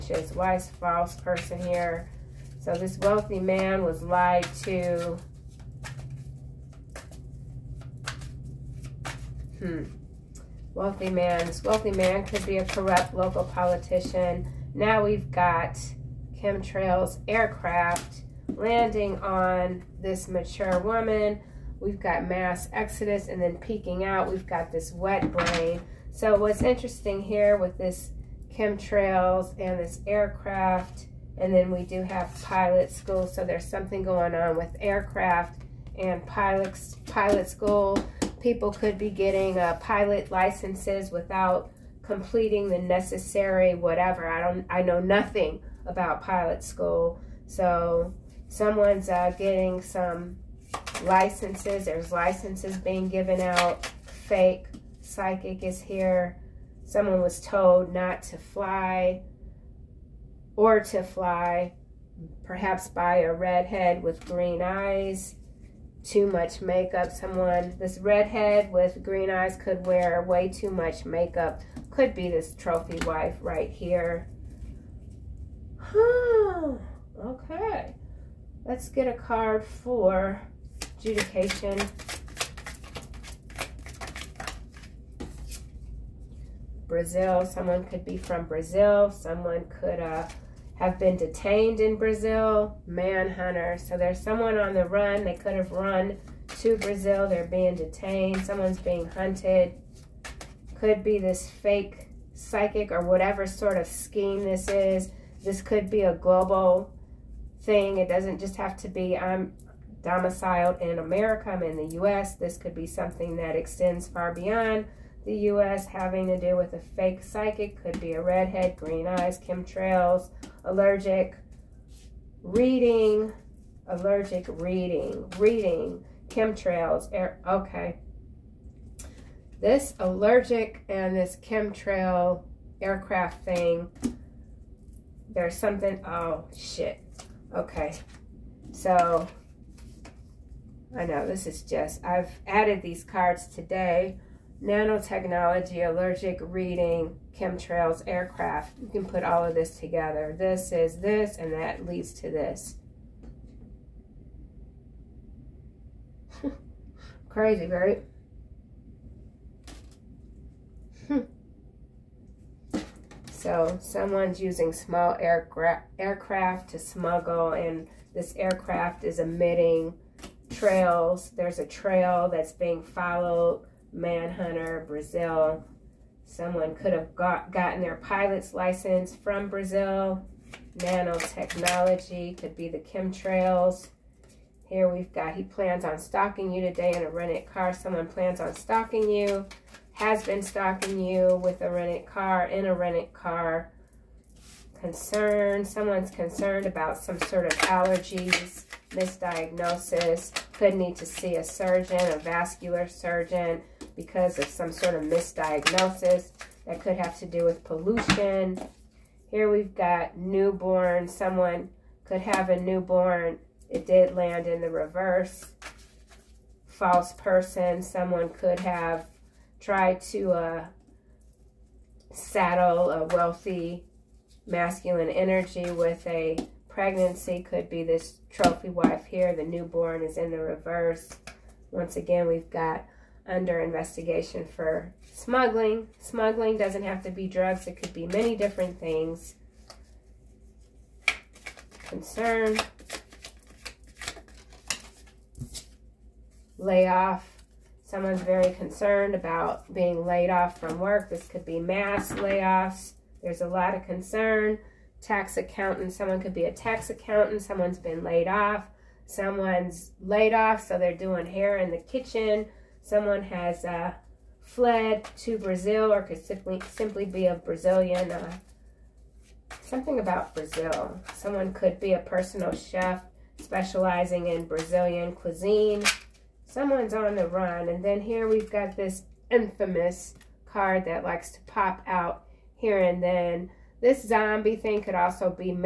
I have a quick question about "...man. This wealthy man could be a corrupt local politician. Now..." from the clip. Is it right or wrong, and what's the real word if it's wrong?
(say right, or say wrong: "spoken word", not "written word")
right.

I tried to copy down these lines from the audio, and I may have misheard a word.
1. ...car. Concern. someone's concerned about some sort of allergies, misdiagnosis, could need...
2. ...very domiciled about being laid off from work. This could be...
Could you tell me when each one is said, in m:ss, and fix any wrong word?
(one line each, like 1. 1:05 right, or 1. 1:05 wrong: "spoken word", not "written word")
1. 3:13 right
2. 4:08 wrong: "concerned", not "domiciled".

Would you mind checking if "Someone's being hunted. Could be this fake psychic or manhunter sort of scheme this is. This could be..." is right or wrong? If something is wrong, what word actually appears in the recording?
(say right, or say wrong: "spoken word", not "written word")
wrong: "whatever", not "manhunter".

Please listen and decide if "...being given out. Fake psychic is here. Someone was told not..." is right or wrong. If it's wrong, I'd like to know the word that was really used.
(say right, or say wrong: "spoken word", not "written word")
right.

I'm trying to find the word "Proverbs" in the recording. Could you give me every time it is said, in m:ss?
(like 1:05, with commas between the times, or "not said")
not said.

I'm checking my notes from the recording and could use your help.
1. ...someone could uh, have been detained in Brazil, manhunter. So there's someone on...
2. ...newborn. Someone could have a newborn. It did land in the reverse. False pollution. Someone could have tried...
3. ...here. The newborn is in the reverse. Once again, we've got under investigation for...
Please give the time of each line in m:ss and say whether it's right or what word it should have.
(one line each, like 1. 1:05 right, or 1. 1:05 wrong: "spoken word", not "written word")
1. 1:29 right
2. 3:30 wrong: "person", not "pollution"
3. 3:49 right.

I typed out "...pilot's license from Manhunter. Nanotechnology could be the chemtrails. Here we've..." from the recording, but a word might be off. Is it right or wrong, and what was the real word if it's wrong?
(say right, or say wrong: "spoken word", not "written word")
wrong: "Brazil", not "Manhunter".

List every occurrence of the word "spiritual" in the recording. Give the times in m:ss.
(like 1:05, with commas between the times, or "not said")
not said.